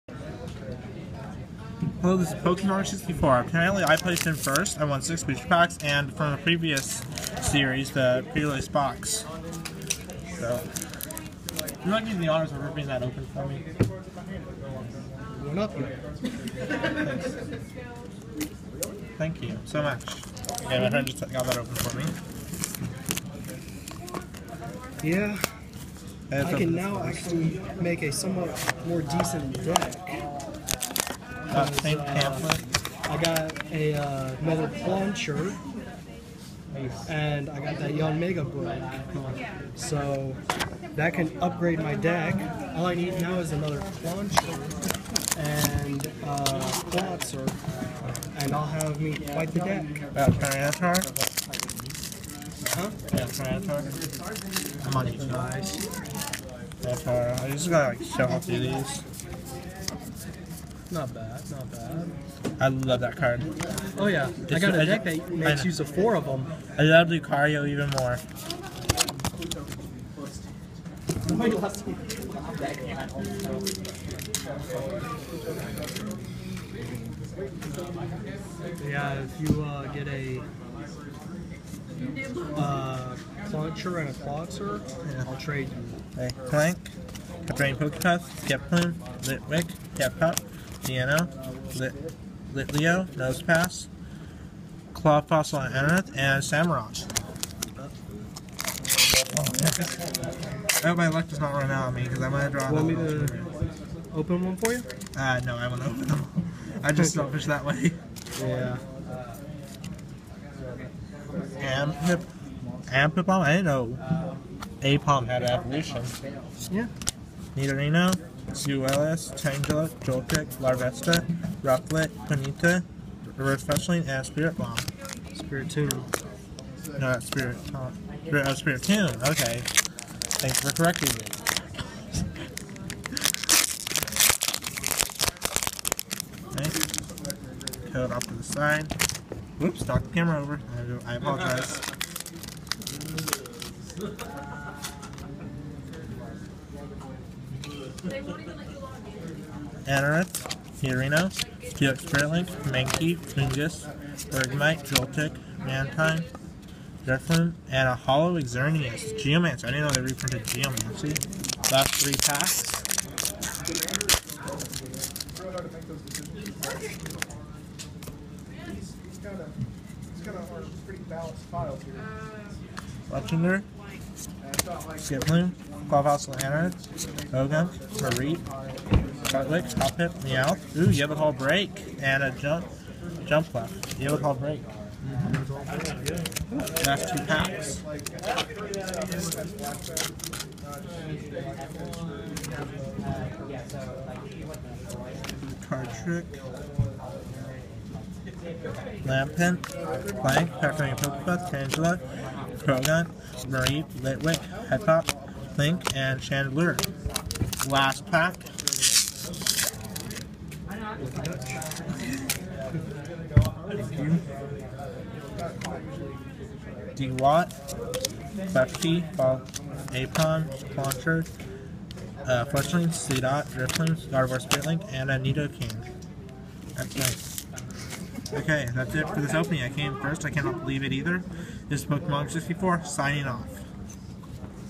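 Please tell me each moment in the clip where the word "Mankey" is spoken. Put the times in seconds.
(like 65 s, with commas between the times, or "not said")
152 s.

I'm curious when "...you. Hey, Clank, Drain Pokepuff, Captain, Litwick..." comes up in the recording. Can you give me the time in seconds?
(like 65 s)
85 s.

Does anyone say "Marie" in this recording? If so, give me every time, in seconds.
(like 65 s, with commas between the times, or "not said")
178 s, 203 s.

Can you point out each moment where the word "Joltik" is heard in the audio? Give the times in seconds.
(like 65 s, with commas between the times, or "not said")
120 s, 154 s.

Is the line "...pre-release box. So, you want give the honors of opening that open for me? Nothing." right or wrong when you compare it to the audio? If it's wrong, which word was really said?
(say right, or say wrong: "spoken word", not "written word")
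wrong: "ripping", not "opening".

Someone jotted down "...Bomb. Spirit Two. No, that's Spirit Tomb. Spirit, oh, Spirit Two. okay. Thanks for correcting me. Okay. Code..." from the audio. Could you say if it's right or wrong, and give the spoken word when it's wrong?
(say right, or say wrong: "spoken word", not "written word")
right.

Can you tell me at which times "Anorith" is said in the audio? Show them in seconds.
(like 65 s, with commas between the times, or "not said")
95 s, 149 s.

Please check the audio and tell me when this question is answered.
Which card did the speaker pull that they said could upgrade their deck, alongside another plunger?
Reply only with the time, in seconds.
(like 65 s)
37 s.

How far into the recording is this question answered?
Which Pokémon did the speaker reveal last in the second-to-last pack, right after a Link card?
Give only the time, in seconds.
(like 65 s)
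206 s.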